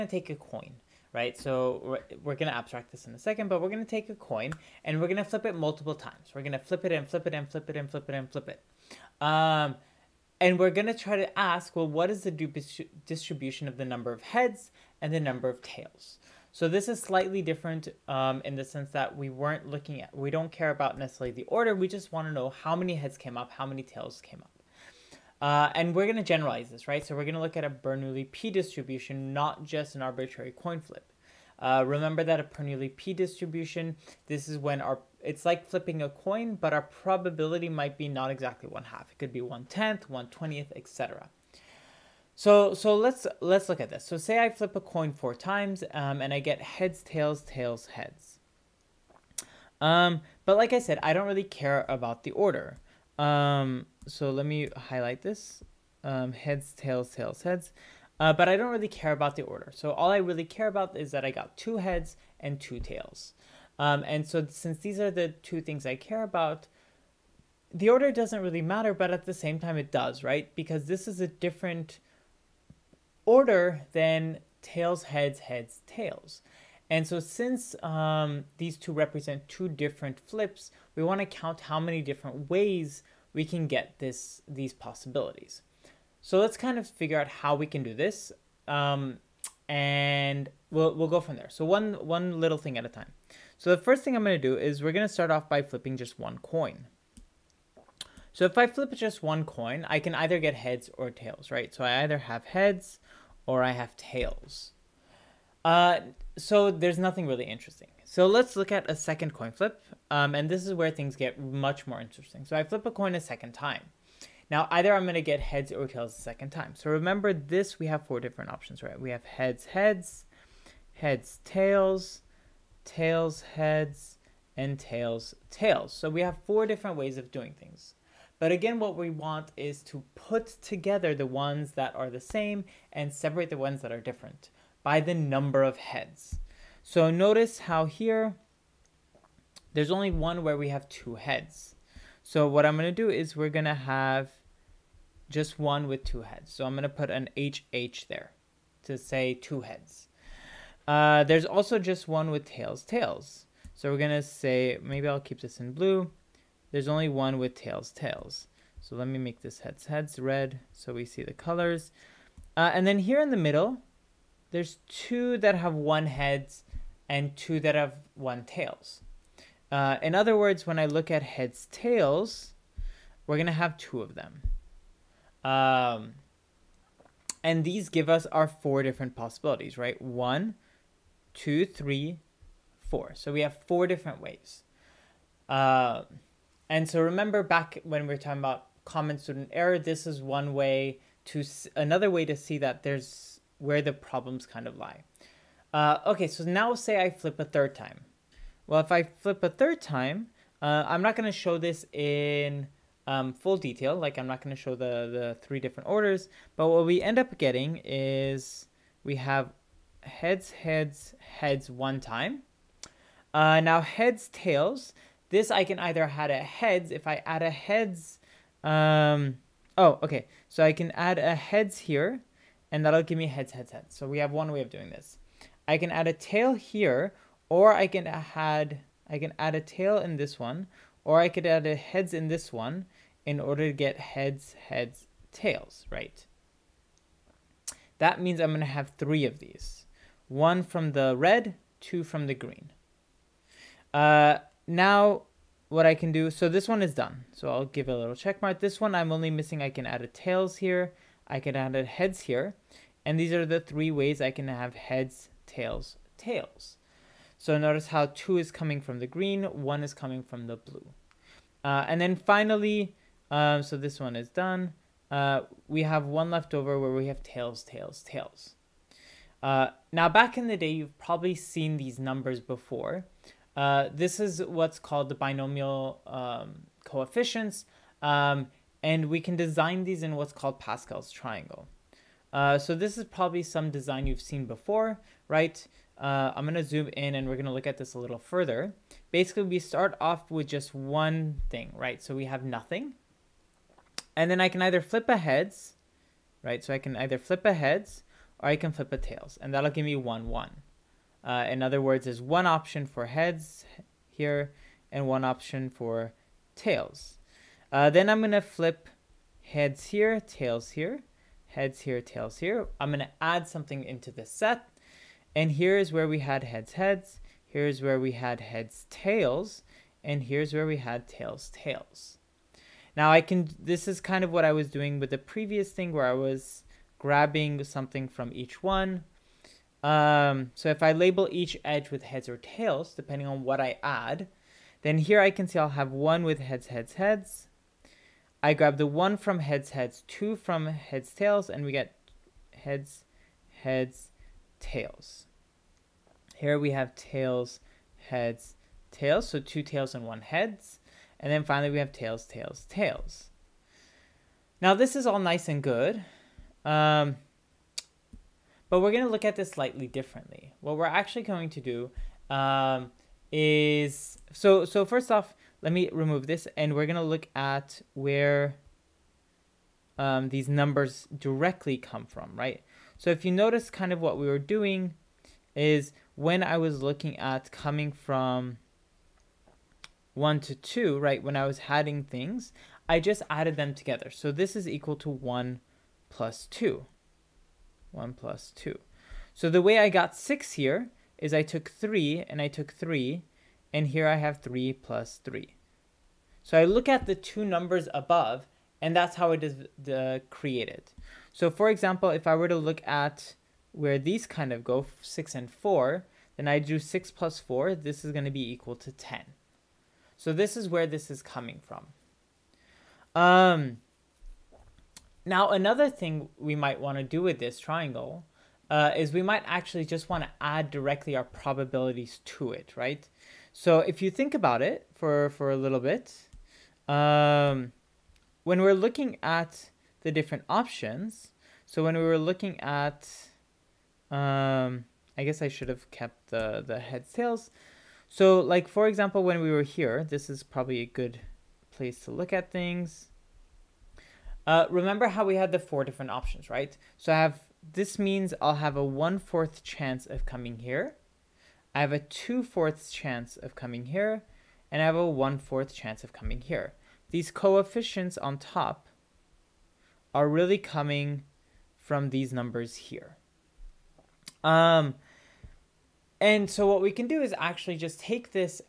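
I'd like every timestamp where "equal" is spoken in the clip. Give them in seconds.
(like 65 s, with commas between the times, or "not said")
384 s, 408 s.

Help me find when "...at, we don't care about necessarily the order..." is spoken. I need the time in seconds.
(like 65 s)
20 s.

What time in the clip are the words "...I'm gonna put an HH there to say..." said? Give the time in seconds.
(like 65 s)
146 s.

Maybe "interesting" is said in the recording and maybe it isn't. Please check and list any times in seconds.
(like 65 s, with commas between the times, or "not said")
107 s, 112 s.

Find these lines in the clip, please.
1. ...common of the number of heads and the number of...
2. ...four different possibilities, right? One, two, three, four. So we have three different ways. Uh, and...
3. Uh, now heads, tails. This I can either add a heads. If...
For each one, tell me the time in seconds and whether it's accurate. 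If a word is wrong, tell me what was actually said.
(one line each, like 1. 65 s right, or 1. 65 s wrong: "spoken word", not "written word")
1. 13 s wrong: "distribution", not "common"
2. 178 s wrong: "four", not "three"
3. 213 s right.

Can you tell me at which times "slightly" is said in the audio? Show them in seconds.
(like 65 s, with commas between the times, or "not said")
17 s, 359 s.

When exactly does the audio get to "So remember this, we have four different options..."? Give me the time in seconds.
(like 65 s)
116 s.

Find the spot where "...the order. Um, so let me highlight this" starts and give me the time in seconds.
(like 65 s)
52 s.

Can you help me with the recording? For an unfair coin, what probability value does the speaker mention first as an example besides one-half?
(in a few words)
one tenth.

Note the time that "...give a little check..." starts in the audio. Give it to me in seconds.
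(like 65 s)
247 s.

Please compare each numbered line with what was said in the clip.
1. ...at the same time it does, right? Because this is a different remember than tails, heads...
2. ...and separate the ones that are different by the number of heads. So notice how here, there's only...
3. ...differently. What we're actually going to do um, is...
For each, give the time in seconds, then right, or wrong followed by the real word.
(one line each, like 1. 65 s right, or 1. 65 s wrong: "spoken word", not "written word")
1. 69 s wrong: "order", not "remember"
2. 132 s right
3. 359 s right.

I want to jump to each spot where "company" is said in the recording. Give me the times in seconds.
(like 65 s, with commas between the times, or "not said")
not said.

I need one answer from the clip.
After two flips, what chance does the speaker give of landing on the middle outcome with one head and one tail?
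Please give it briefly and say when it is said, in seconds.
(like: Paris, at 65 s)
two-fourths, at 451 s.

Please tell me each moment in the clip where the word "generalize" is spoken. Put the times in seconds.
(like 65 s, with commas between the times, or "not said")
26 s.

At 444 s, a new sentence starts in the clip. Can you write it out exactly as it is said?
Uh, remember how we had the four different options, right?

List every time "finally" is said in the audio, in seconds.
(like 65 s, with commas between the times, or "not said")
262 s, 351 s.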